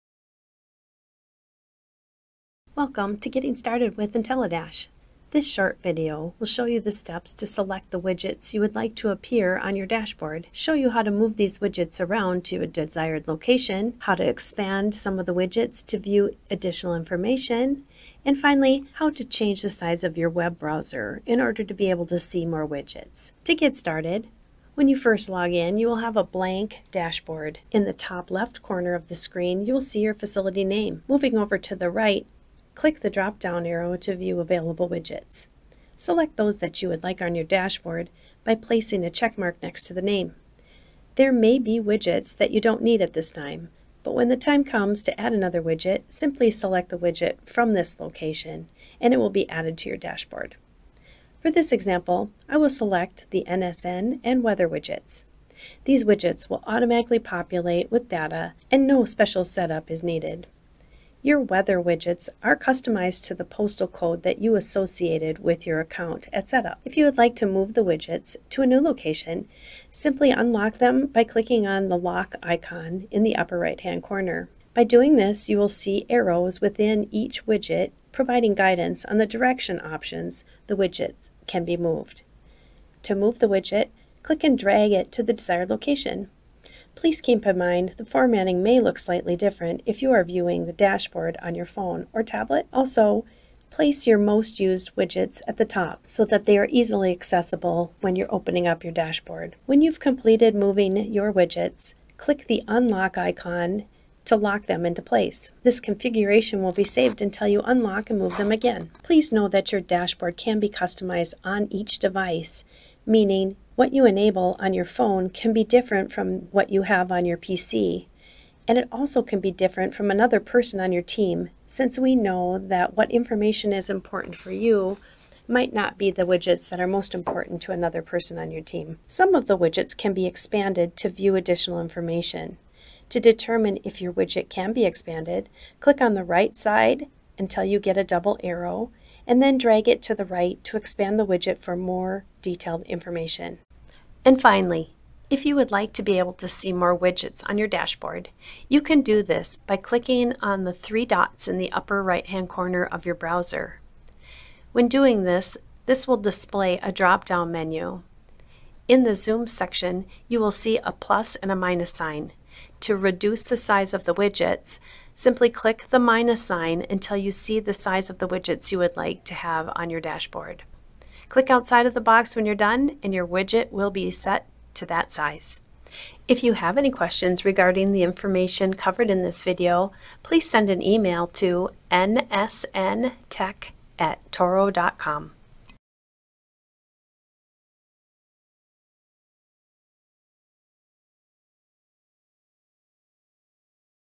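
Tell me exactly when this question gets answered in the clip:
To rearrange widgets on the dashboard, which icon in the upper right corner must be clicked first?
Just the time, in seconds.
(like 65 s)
71 s.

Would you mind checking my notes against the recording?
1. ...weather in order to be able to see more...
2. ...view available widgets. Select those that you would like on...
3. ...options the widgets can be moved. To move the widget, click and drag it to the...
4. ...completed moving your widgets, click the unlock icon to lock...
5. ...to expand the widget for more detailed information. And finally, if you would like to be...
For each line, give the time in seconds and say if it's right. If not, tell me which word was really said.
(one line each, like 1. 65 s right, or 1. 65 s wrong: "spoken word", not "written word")
1. 20 s wrong: "browser", not "weather"
2. 34 s right
3. 79 s right
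4. 100 s right
5. 140 s right.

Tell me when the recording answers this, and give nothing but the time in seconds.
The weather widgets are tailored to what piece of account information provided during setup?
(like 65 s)
63 s.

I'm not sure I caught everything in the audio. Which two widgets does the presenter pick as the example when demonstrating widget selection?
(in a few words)
NSN and weather.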